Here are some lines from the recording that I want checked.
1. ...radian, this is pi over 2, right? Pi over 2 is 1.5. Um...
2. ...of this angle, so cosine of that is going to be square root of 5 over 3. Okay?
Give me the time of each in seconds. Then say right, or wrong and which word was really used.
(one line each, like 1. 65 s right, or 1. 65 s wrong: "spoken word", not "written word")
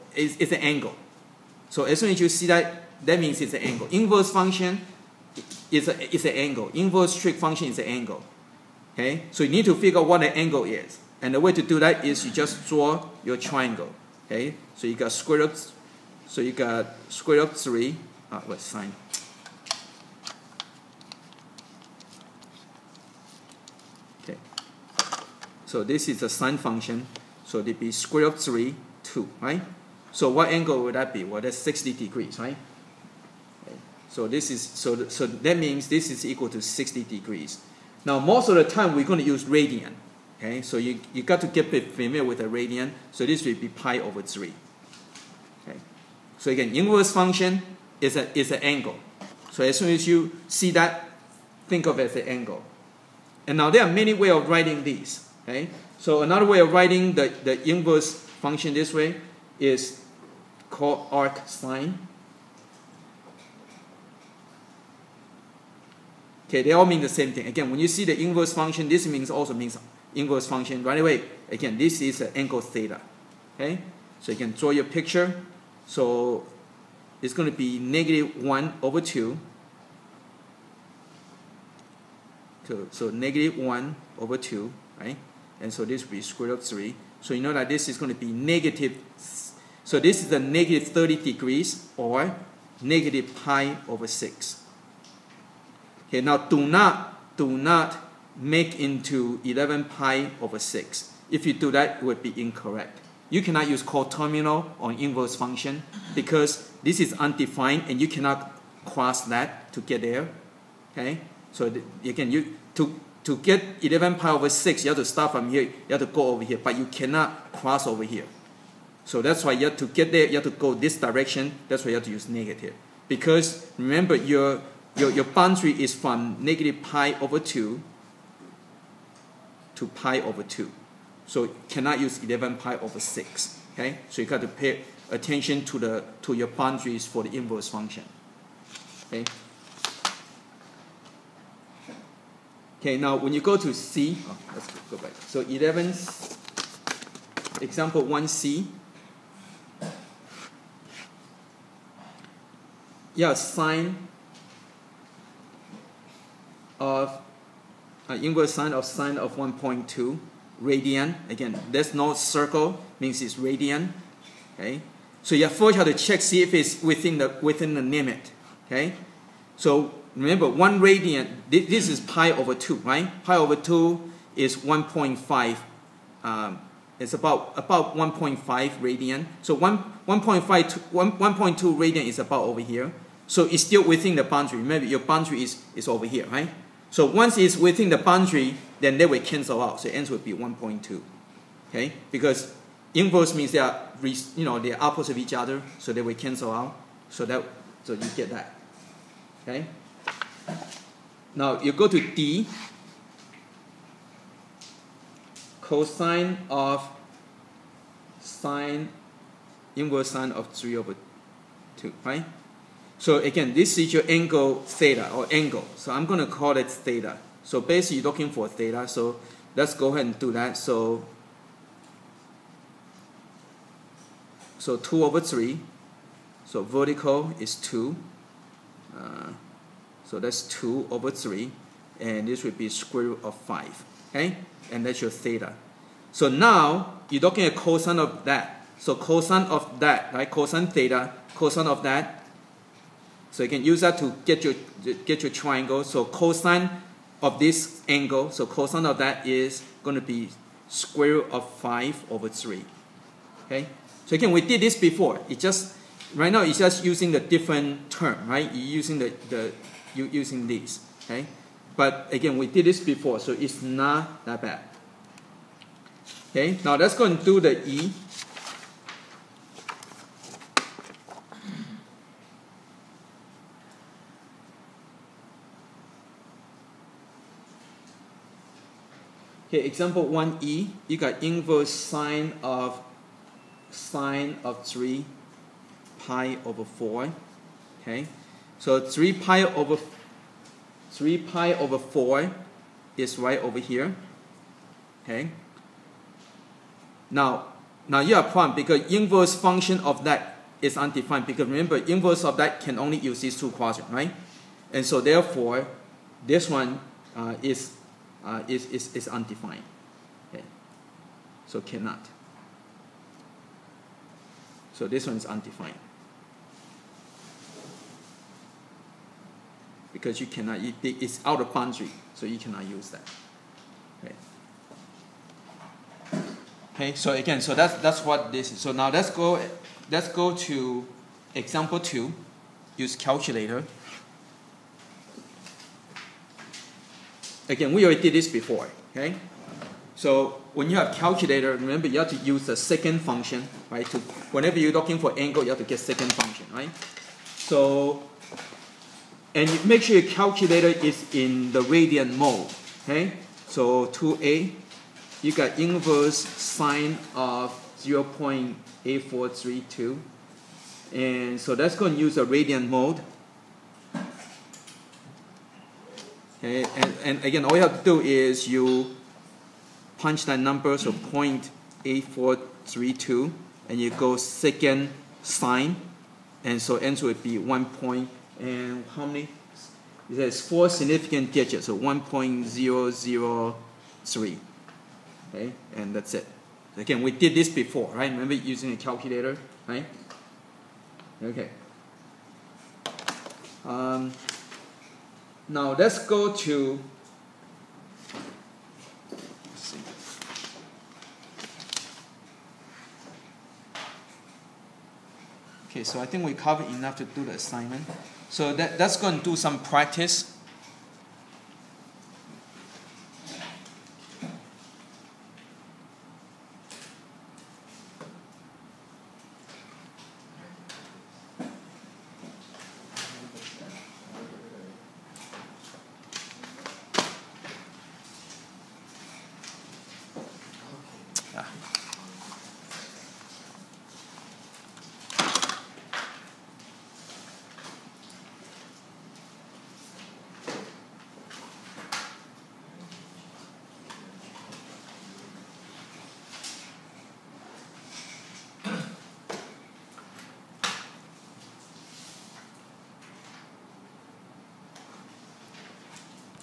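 1. 170 s right
2. 247 s right.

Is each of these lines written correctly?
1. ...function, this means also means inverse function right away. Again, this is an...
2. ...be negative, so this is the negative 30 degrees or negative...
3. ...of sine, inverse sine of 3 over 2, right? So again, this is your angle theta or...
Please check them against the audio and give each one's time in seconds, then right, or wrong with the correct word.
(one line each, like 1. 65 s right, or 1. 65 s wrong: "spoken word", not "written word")
1. 68 s right
2. 88 s right
3. 206 s right.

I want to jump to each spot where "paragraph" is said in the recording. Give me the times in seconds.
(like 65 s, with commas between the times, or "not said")
not said.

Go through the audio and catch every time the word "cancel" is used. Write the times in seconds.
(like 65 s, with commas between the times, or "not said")
189 s, 196 s.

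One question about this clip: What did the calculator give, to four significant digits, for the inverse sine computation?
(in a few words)
1.003.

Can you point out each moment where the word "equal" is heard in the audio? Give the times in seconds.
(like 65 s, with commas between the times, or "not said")
36 s.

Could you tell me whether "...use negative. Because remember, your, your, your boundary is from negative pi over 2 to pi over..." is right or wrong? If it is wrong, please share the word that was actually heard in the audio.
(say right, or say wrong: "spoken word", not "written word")
right.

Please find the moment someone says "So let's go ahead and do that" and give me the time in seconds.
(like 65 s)
218 s.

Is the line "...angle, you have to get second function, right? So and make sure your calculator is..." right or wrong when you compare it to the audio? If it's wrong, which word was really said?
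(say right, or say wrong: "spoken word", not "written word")
right.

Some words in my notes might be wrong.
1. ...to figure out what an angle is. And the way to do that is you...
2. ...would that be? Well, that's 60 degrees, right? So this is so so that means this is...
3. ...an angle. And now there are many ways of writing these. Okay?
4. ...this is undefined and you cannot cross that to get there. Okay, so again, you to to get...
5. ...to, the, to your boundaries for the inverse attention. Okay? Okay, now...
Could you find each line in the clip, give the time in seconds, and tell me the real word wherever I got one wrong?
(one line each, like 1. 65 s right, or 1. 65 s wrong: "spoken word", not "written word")
1. 9 s right
2. 30 s right
3. 52 s right
4. 106 s right
5. 135 s wrong: "function", not "attention".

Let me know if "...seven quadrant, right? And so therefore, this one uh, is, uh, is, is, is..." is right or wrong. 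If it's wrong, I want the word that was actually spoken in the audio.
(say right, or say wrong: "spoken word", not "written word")
wrong: "two", not "seven".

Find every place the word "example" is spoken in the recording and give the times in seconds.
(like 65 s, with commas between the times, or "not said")
147 s, 279 s, 331 s.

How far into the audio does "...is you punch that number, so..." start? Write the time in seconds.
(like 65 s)
368 s.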